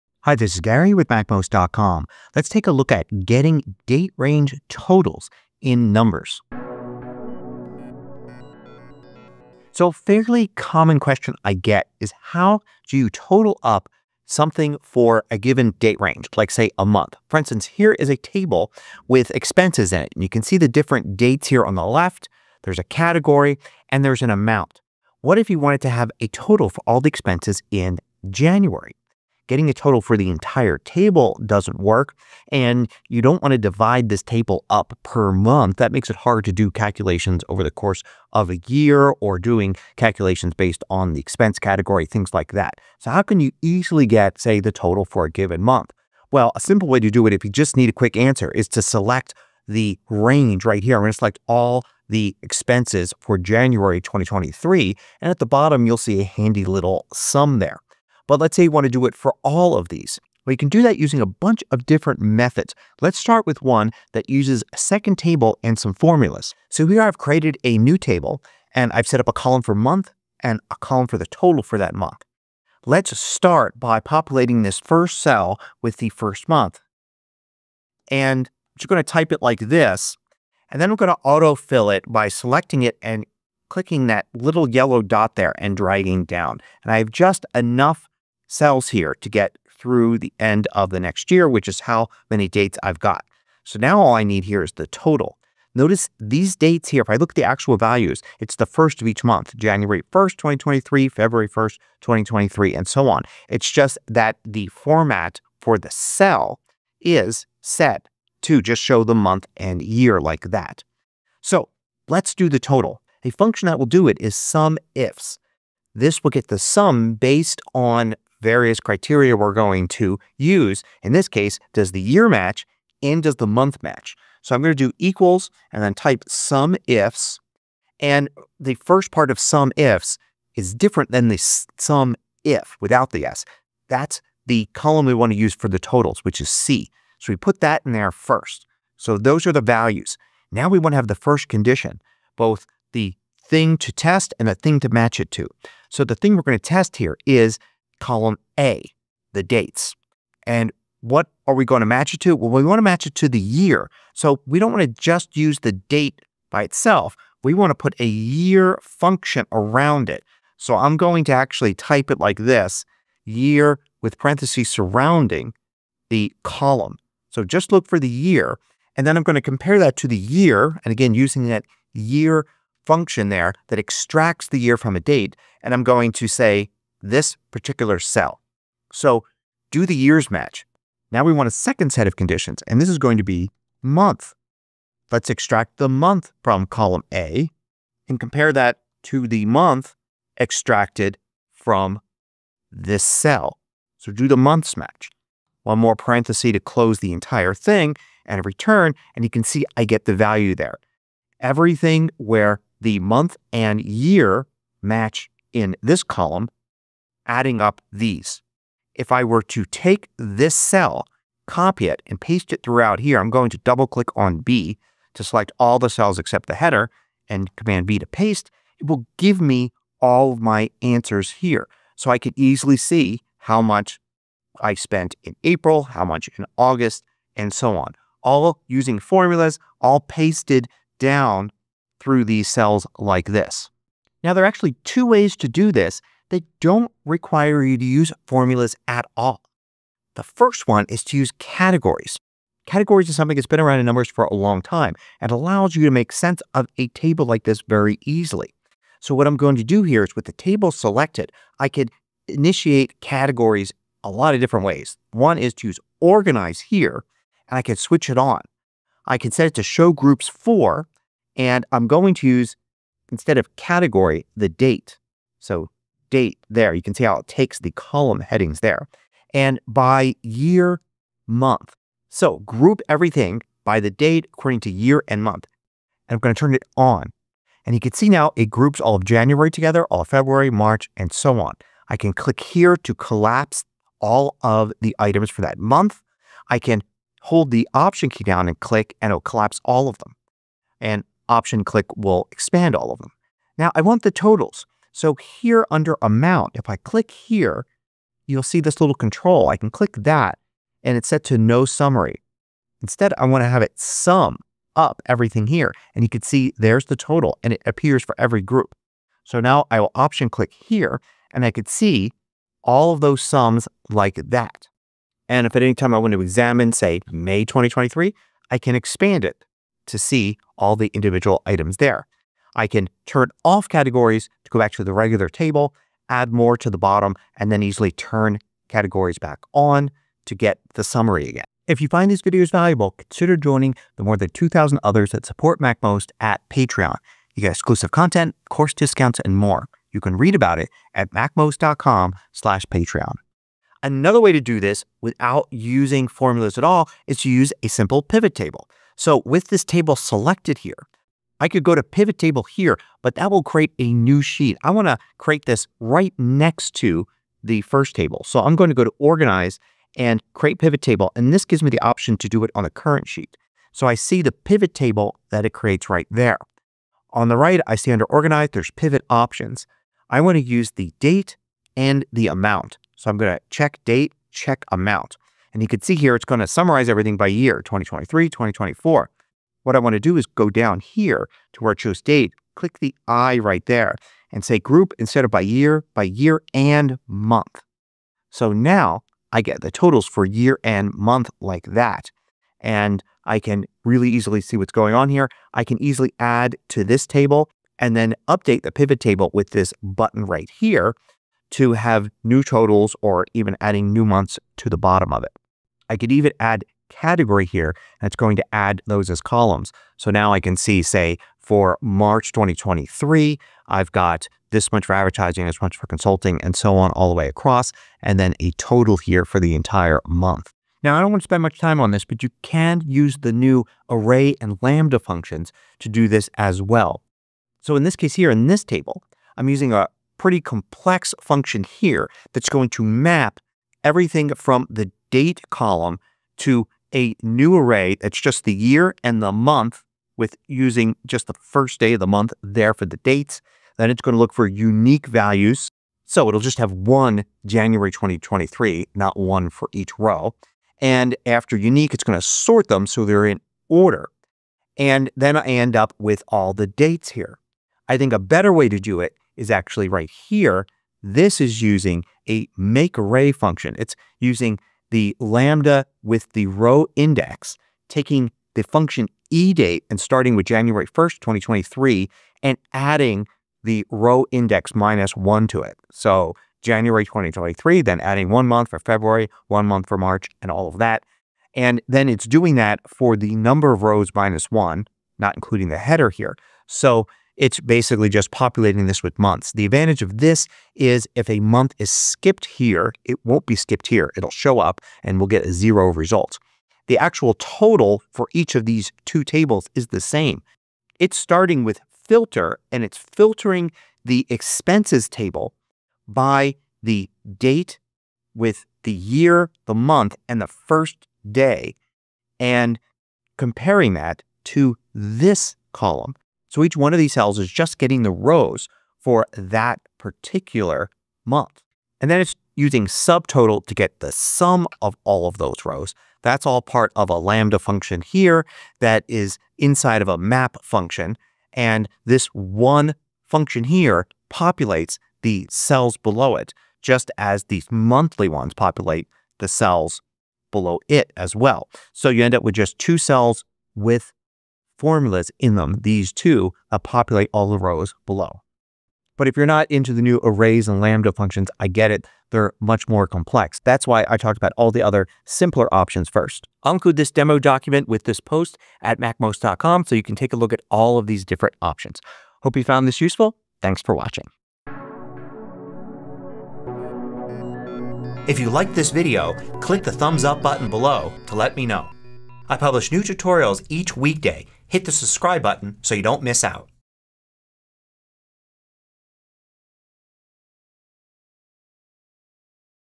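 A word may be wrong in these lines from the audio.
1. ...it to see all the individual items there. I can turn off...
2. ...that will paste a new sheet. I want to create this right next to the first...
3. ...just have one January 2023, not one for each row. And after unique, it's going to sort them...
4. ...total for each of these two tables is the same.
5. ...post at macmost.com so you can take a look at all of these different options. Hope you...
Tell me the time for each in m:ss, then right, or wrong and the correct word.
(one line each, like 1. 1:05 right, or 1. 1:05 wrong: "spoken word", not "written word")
1. 5:19 right
2. 5:53 wrong: "create", not "paste"
3. 7:26 right
4. 8:17 right
5. 9:18 right.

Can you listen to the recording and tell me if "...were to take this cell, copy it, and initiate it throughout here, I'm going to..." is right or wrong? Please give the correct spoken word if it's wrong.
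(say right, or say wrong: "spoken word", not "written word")
wrong: "paste", not "initiate".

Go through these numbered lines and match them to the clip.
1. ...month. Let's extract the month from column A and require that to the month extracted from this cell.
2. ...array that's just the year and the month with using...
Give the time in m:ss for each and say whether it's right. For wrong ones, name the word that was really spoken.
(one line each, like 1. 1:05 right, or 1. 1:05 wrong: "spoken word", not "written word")
1. 3:03 wrong: "compare", not "require"
2. 7:17 right.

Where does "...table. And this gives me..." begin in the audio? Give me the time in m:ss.
6:00.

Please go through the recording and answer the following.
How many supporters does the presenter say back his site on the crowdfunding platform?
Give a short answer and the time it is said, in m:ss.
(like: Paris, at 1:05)
more than 2,000, at 5:34.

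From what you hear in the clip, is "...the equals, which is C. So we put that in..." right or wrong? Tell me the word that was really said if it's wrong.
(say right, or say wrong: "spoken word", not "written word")
wrong: "totals", not "equals".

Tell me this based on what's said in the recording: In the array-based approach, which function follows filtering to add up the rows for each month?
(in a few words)
SUBTOTAL.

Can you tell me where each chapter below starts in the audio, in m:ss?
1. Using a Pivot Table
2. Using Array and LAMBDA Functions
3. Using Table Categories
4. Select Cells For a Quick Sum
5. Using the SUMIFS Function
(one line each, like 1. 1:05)
1. 5:43
2. 7:00
3. 3:53
4. 0:42
5. 1:06.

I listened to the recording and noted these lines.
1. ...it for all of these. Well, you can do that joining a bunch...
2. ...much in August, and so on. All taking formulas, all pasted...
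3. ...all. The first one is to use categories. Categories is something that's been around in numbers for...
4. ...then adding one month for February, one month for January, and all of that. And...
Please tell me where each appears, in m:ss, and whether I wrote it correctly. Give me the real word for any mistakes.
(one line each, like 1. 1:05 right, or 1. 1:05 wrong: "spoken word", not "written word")
1. 0:59 wrong: "using", not "joining"
2. 3:46 wrong: "using", not "taking"
3. 3:59 right
4. 7:57 wrong: "March", not "January".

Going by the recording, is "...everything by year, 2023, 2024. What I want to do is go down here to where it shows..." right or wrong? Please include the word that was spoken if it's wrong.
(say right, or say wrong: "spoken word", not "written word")
right.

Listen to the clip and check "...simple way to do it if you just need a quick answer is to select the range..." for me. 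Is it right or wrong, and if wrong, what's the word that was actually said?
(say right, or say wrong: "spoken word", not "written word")
right.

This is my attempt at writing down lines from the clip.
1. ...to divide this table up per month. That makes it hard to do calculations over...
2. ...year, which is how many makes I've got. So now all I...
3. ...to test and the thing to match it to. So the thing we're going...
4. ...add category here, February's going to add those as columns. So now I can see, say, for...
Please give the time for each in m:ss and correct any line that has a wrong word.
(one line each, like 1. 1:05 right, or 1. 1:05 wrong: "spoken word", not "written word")
1. 0:33 right
2. 1:31 wrong: "dates", not "makes"
3. 2:23 right
4. 6:46 wrong: "That", not "February".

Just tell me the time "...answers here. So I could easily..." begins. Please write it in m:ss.
3:40.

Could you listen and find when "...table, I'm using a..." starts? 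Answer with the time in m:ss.
7:08.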